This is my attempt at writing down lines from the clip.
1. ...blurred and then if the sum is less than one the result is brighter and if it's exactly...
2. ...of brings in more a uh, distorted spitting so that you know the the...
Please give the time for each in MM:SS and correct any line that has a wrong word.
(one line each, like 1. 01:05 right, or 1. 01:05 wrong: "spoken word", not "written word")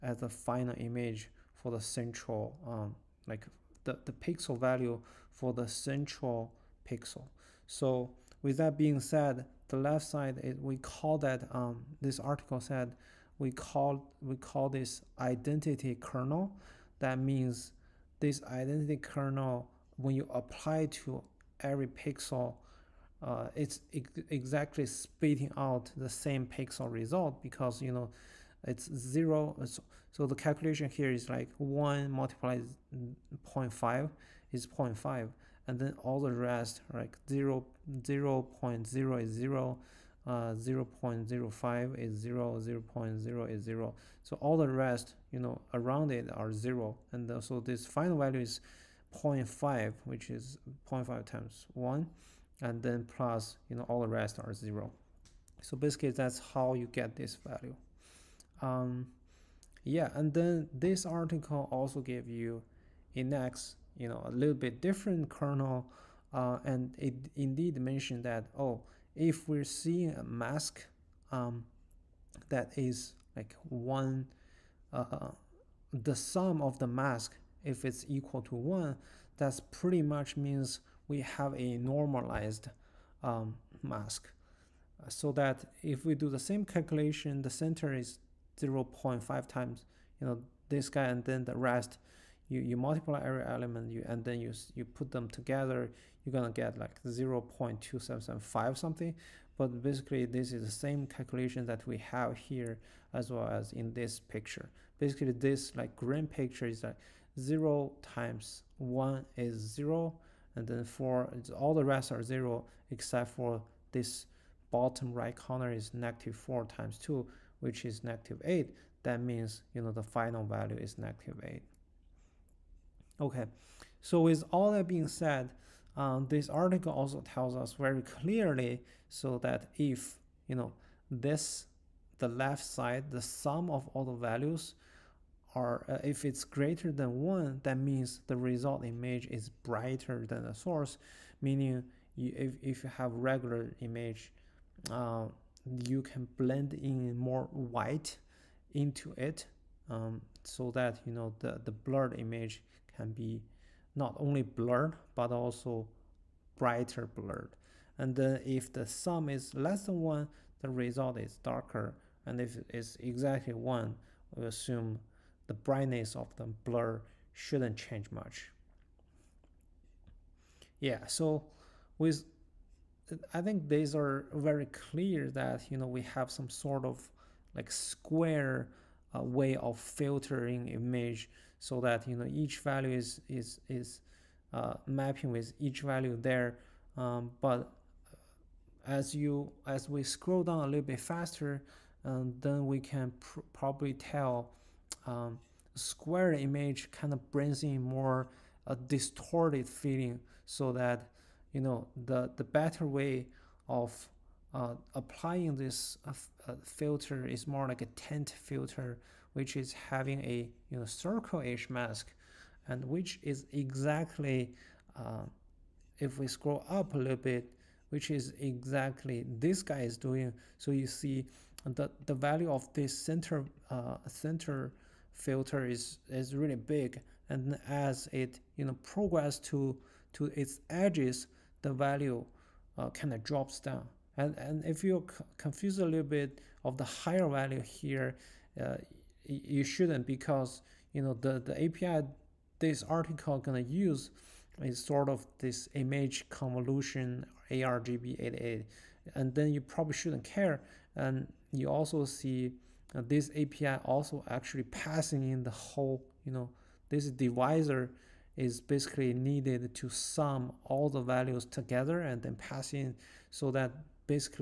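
1. 02:37 wrong: "darker", not "brighter"
2. 03:17 wrong: "feeling", not "spitting".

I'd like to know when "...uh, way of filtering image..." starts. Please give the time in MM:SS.
02:59.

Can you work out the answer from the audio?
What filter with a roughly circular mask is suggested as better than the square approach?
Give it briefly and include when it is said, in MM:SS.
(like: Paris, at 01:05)
tent filter, at 03:27.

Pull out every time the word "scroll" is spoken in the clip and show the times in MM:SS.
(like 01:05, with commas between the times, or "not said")
03:10, 03:36.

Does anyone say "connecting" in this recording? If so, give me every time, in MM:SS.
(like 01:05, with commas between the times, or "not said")
not said.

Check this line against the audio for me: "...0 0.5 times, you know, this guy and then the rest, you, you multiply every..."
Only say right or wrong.
right.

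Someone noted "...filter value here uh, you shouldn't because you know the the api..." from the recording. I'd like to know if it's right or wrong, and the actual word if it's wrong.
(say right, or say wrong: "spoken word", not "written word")
wrong: "higher", not "filter".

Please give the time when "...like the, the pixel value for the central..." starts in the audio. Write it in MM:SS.
00:03.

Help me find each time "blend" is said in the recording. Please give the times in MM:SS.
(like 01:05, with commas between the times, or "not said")
02:26.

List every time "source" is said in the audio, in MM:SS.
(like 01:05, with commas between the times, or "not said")
02:20.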